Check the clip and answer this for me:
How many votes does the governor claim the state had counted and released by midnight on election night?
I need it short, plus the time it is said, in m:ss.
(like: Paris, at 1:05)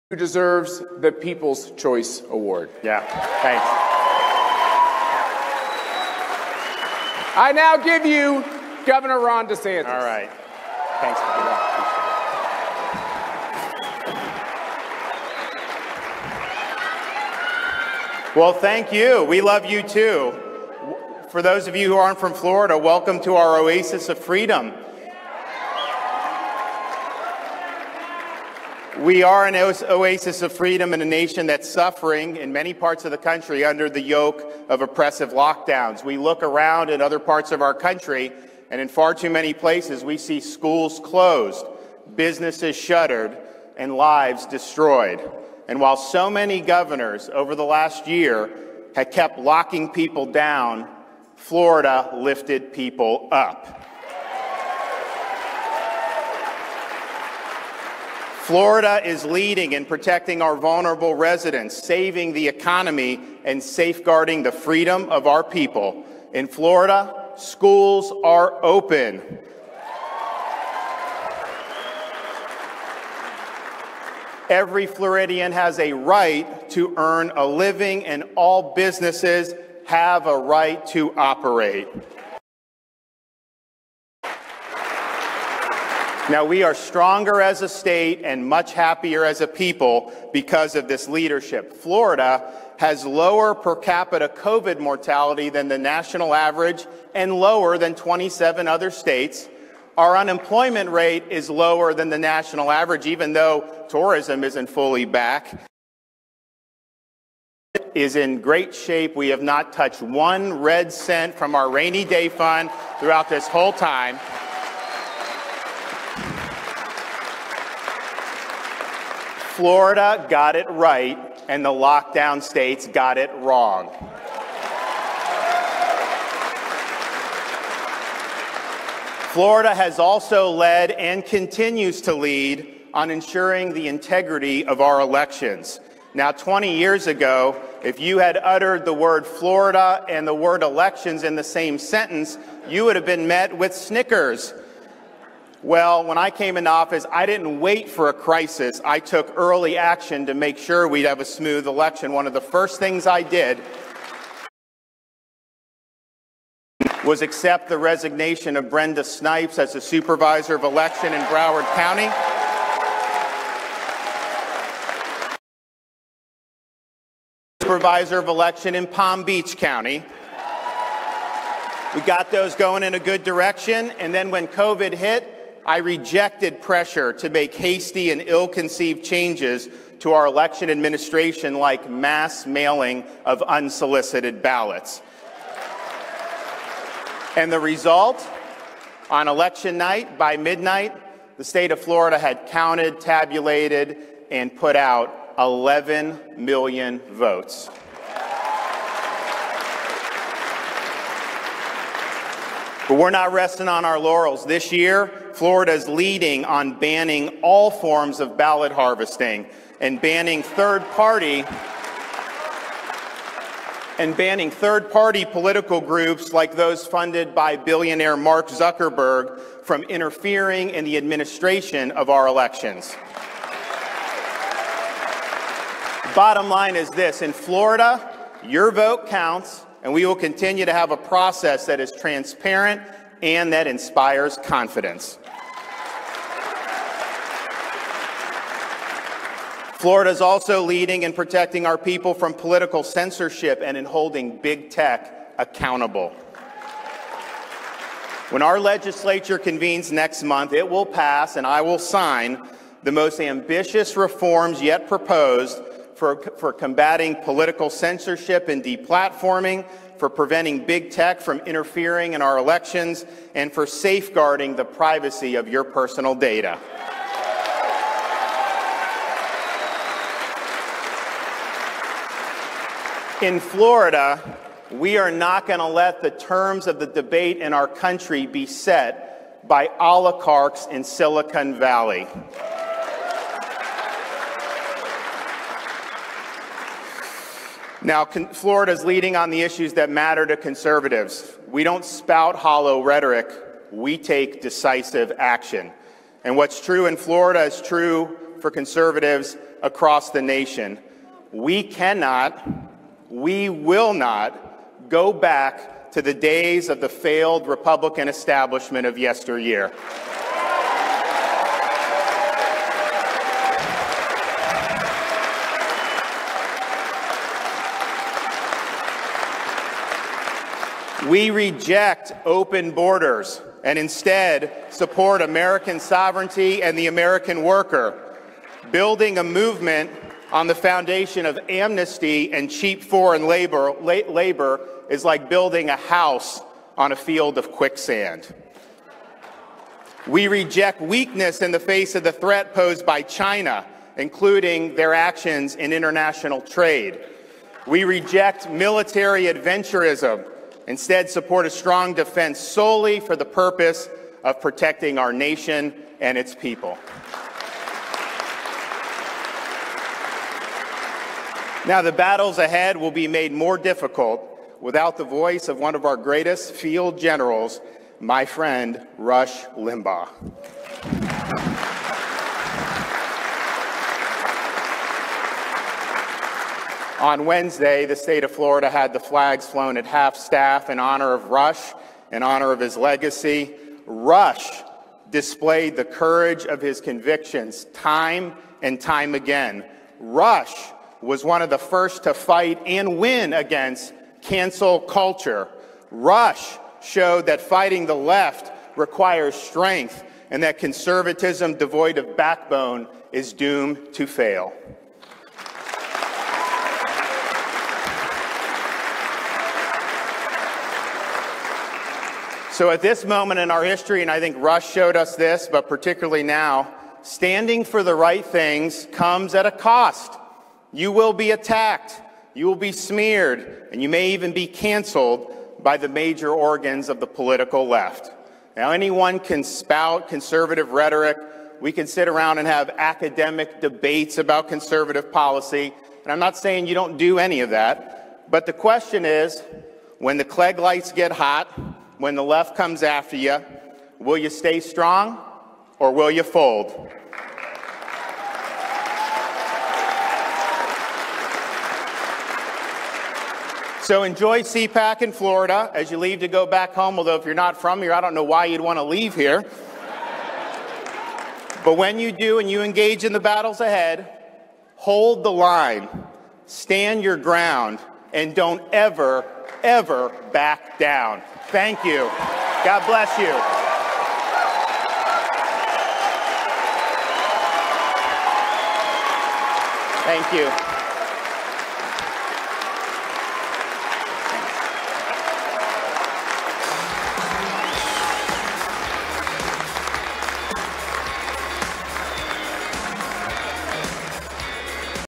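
11 million, at 3:15.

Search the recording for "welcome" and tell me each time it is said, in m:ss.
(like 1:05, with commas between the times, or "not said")
0:22.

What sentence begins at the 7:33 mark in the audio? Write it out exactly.
So enjoy CPAC in Florida as you leave to go back home.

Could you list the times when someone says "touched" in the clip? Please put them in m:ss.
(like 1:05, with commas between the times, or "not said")
1:49.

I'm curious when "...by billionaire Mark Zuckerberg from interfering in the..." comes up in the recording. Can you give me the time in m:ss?
3:37.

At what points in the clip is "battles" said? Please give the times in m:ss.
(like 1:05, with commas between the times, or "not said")
6:01, 7:43.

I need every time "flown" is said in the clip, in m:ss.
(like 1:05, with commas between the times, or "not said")
6:19.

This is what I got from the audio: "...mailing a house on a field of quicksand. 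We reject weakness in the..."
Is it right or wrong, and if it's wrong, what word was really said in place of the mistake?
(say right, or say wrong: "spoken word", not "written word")
wrong: "building", not "mailing".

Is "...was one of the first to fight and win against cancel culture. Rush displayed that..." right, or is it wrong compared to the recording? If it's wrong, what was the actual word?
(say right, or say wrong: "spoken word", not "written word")
wrong: "showed", not "displayed".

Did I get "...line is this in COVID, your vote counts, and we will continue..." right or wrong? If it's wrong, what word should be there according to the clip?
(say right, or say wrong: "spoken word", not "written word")
wrong: "Florida", not "COVID".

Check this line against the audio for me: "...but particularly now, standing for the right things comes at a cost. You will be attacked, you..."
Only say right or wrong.
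right.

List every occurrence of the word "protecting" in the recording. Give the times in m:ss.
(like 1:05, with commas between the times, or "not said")
0:59, 4:01, 5:54.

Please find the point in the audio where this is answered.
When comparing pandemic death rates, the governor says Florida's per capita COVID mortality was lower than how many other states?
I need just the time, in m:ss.
1:37.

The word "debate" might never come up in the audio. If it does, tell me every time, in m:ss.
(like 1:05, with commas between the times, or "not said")
4:36, 7:13.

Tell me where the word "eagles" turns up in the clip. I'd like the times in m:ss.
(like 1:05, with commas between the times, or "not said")
not said.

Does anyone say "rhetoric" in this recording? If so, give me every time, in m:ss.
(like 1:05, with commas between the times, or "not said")
4:52, 7:10.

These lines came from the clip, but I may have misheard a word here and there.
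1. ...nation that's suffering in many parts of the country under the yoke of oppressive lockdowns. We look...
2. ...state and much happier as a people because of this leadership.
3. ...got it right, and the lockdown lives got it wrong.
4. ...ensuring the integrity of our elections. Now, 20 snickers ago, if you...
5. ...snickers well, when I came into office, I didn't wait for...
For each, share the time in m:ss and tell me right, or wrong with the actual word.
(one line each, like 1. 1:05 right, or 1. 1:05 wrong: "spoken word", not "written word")
1. 0:31 right
2. 1:27 right
3. 2:00 wrong: "states", not "lives"
4. 2:13 wrong: "years", not "snickers"
5. 2:23 right.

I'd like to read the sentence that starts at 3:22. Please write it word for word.
But we're not resting on our laurels.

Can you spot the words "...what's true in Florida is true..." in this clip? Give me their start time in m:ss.
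4:56.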